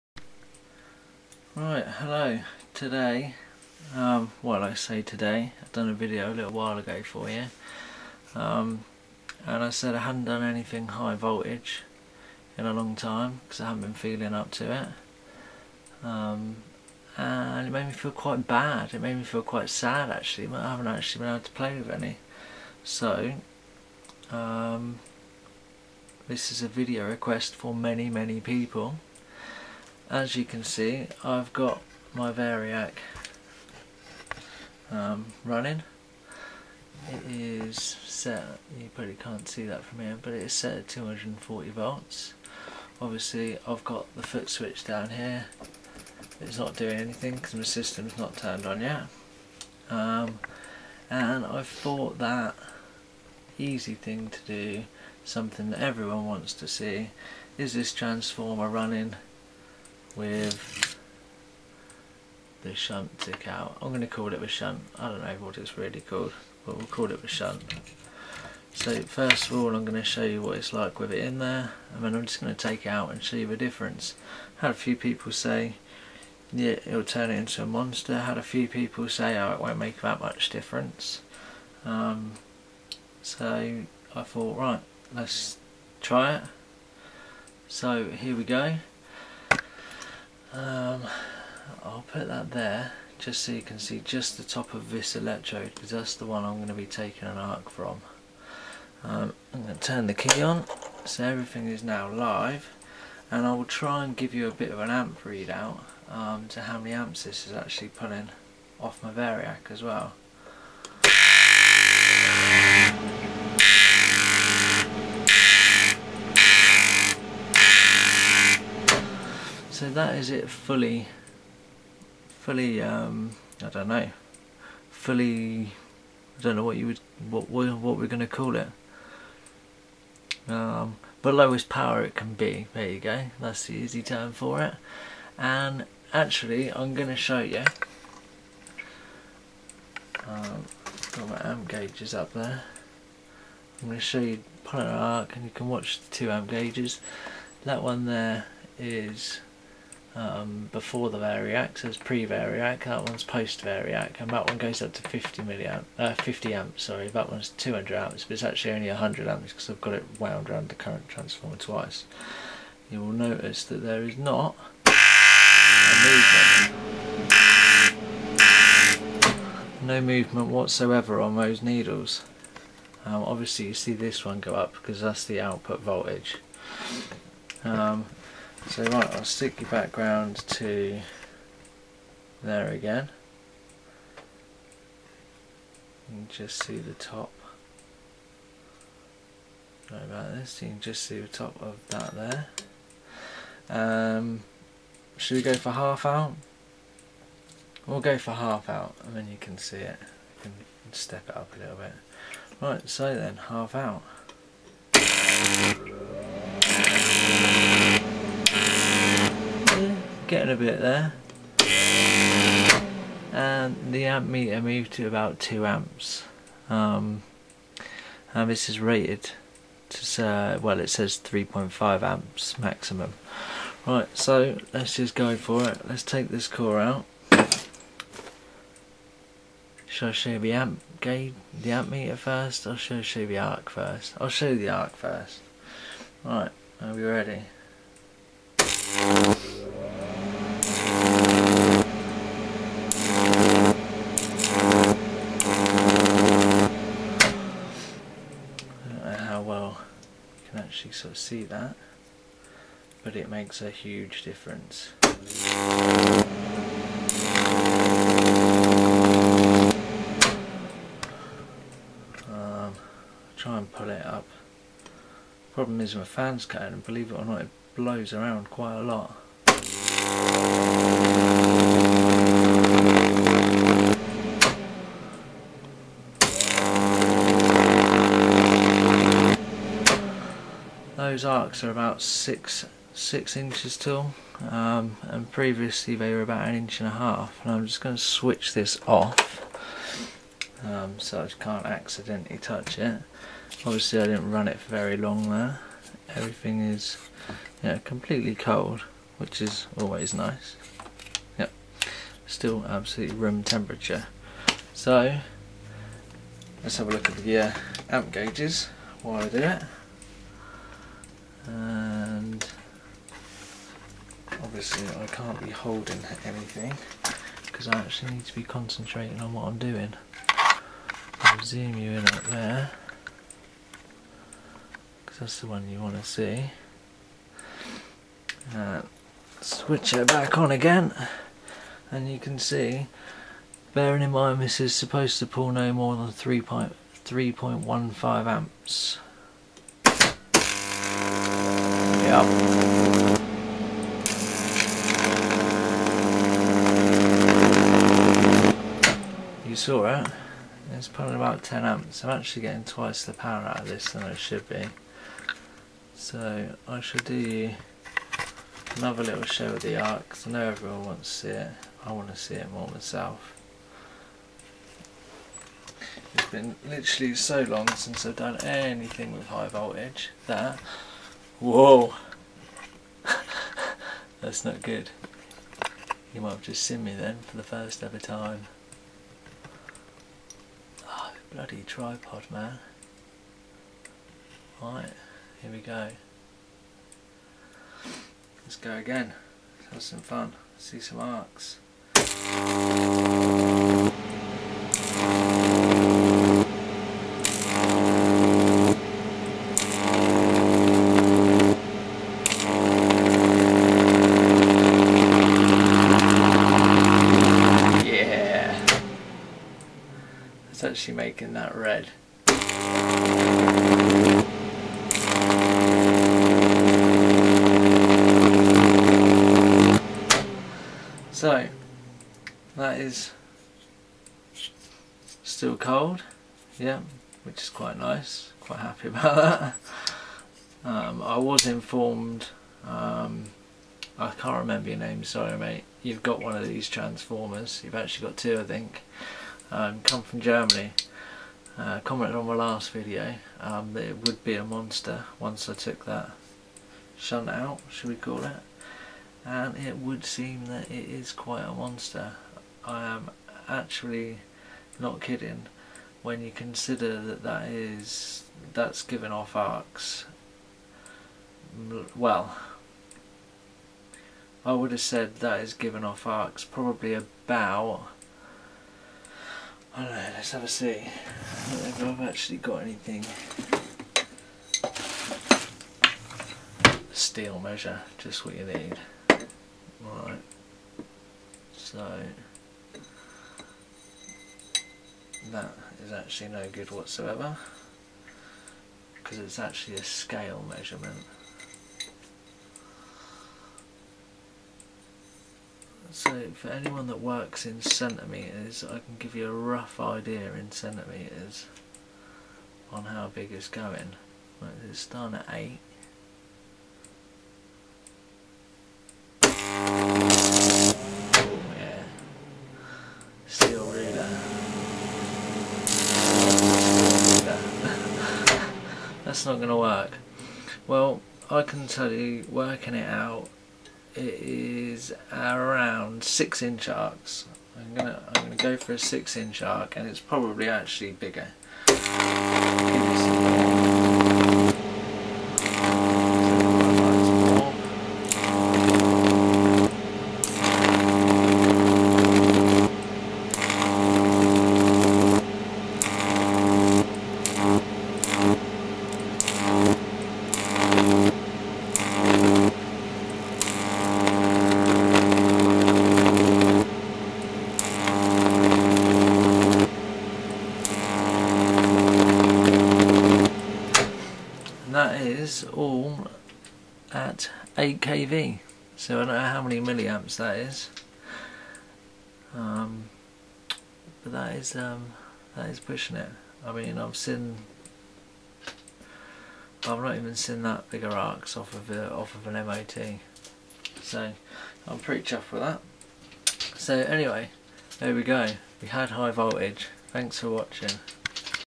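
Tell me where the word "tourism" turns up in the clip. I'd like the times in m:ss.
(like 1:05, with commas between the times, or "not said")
not said.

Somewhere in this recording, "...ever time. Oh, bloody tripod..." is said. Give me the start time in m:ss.
6:17.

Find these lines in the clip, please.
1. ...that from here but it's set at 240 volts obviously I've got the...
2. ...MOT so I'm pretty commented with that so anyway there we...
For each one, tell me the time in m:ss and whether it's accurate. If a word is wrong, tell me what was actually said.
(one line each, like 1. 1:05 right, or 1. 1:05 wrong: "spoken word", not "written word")
1. 0:39 right
2. 9:42 wrong: "chuffed", not "commented".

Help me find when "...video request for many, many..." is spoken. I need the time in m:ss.
0:26.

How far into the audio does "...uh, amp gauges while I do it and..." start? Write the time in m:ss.
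5:07.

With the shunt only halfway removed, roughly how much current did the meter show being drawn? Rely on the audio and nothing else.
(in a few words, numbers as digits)
2 amps.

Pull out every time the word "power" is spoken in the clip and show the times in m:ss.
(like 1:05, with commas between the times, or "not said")
2:11, 5:53.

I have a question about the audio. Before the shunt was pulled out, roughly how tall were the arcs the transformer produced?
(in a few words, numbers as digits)
an inch and a half.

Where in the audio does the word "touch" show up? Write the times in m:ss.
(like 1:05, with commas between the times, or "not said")
4:52.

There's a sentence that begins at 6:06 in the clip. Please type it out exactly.
It's been literally so long since I've done anything with high voltage that Whoa.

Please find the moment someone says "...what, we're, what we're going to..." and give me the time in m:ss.
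2:07.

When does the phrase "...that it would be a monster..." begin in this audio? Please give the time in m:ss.
7:23.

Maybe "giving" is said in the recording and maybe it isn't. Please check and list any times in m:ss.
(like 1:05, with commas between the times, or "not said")
7:38, 7:45.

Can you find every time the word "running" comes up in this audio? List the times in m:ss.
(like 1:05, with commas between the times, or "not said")
0:35, 0:58.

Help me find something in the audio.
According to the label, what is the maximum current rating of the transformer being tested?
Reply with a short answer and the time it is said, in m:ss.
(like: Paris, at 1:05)
3.5 amps, at 3:41.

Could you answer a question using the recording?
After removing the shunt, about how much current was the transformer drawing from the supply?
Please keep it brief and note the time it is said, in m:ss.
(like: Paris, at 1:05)
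10 amps, at 5:51.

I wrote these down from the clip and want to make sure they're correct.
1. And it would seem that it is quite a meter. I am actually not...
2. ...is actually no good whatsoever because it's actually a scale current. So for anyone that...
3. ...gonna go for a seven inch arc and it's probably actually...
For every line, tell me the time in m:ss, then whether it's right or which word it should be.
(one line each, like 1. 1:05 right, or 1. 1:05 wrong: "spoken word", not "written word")
1. 7:29 wrong: "monster", not "meter"
2. 8:05 wrong: "measurement", not "current"
3. 8:48 wrong: "six", not "seven".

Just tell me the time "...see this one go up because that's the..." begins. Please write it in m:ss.
2:53.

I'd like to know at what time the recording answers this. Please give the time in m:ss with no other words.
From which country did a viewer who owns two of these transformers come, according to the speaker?
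7:20.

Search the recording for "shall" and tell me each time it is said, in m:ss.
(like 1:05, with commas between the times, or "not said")
3:49, 5:56.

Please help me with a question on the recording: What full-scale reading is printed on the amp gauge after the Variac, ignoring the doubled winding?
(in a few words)
200 amps.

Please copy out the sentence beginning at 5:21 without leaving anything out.
I'll zoom you in up there because that's the one you want to see.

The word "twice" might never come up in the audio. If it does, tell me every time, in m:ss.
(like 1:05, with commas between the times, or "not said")
2:41, 5:52.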